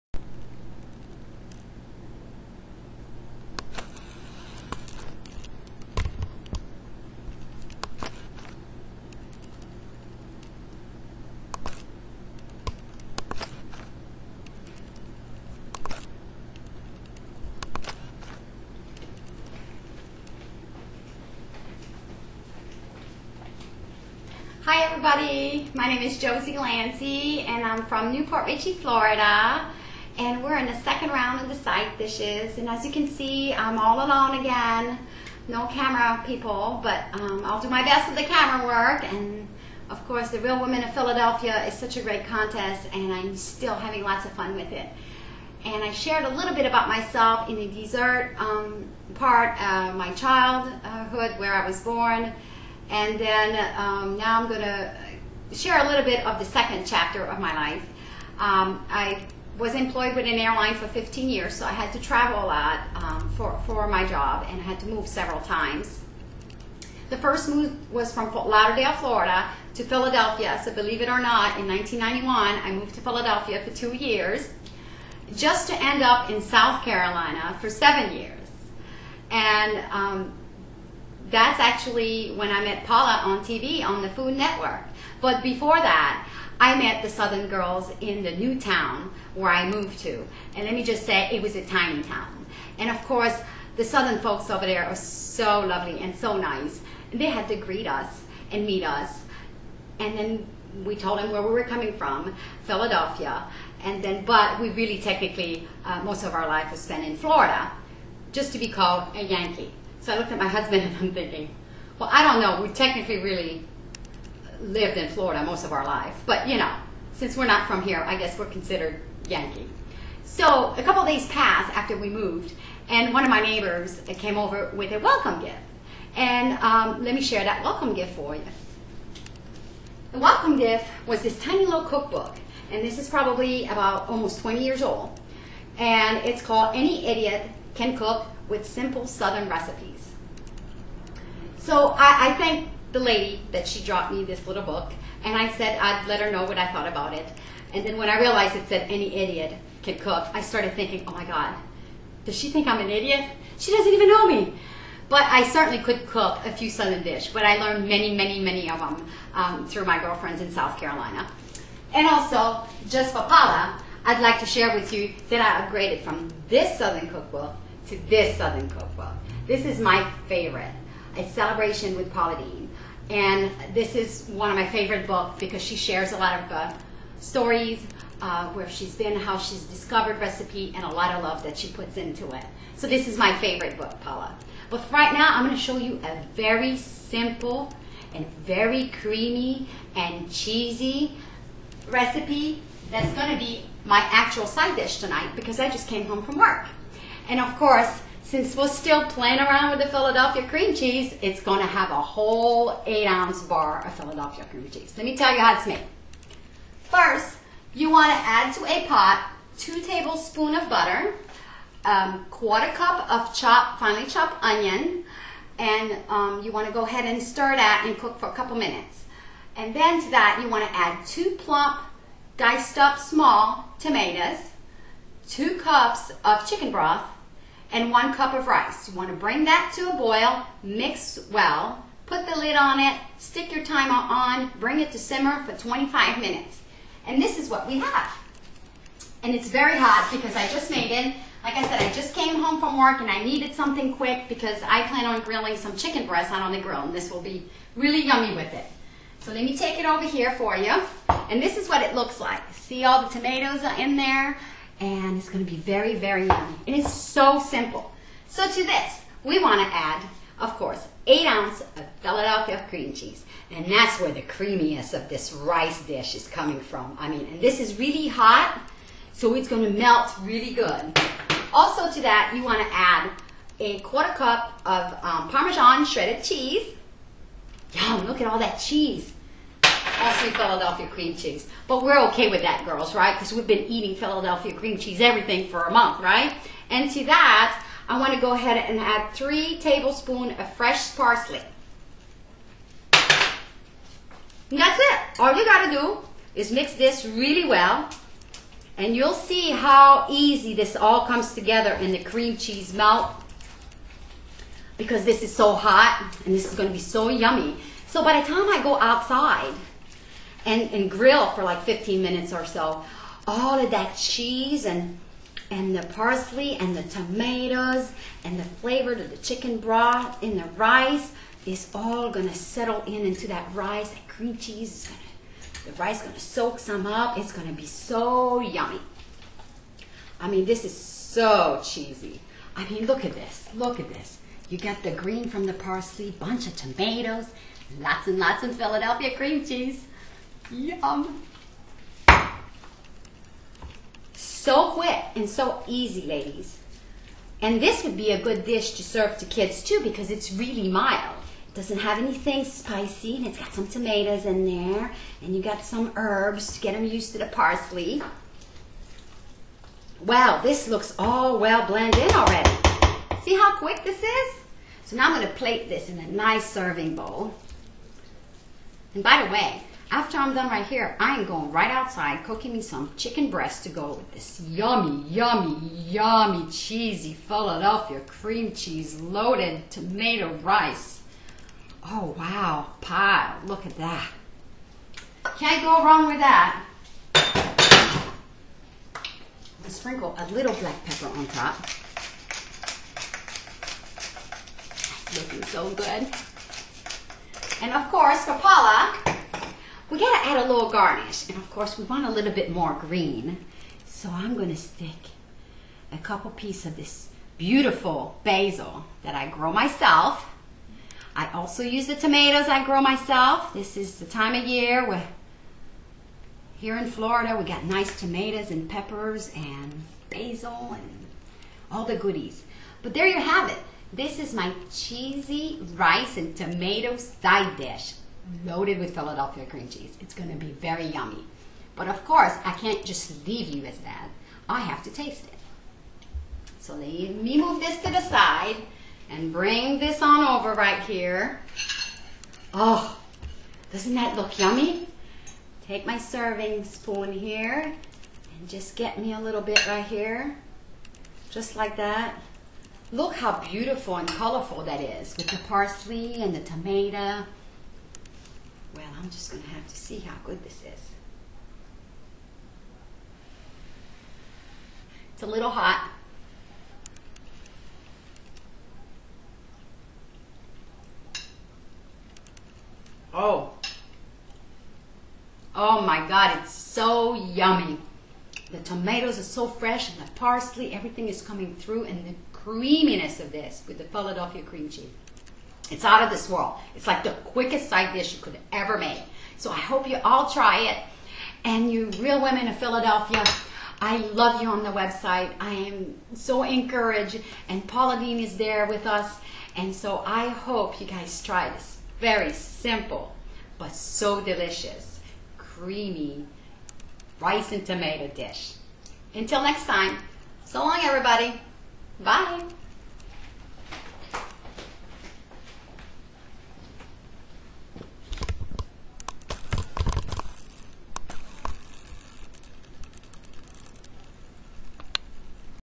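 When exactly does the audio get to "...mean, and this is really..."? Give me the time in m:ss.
4:27.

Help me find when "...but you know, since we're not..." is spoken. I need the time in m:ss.
1:56.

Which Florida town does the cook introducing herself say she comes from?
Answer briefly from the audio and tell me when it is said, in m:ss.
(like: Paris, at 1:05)
New Port Richey, at 0:28.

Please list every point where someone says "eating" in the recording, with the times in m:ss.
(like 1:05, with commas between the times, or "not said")
4:43.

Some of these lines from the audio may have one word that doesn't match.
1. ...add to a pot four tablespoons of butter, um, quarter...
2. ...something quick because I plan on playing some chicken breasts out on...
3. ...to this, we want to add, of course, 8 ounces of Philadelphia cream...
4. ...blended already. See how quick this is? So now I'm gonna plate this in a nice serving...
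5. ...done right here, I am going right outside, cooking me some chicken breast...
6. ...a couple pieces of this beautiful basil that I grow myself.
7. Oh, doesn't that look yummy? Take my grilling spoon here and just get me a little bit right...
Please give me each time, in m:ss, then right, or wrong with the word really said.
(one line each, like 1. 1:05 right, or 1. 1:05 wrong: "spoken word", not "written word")
1. 3:28 wrong: "two", not "four"
2. 4:03 wrong: "grilling", not "playing"
3. 4:18 right
4. 6:01 right
5. 6:10 right
6. 6:45 right
7. 7:22 wrong: "serving", not "grilling".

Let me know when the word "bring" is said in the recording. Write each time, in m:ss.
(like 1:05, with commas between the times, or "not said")
3:49, 3:54, 7:19.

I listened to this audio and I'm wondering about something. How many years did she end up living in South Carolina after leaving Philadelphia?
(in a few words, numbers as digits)
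7.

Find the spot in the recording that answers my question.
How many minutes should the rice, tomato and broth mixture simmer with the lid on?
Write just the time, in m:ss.
3:55.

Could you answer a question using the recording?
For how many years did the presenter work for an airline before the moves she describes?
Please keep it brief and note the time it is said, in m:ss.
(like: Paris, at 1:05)
15, at 1:00.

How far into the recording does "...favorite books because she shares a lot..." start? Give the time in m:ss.
2:54.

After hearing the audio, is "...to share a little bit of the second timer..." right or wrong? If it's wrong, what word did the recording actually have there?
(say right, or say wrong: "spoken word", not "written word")
wrong: "chapter", not "timer".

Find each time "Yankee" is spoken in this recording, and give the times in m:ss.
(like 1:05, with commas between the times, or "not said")
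1:49, 1:59.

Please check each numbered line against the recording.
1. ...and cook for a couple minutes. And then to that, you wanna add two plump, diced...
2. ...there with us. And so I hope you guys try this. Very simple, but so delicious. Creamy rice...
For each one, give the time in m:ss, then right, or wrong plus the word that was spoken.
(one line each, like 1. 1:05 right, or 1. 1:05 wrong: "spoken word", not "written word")
1. 3:37 right
2. 8:18 right.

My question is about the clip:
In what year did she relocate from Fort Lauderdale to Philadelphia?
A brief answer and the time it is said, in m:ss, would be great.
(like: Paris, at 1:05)
1991, at 1:11.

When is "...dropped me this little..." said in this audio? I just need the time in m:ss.
2:23.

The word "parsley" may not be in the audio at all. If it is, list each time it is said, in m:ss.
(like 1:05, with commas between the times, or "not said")
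4:50, 5:15, 5:35, 5:57, 7:35, 8:00.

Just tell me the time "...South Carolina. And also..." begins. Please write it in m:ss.
2:40.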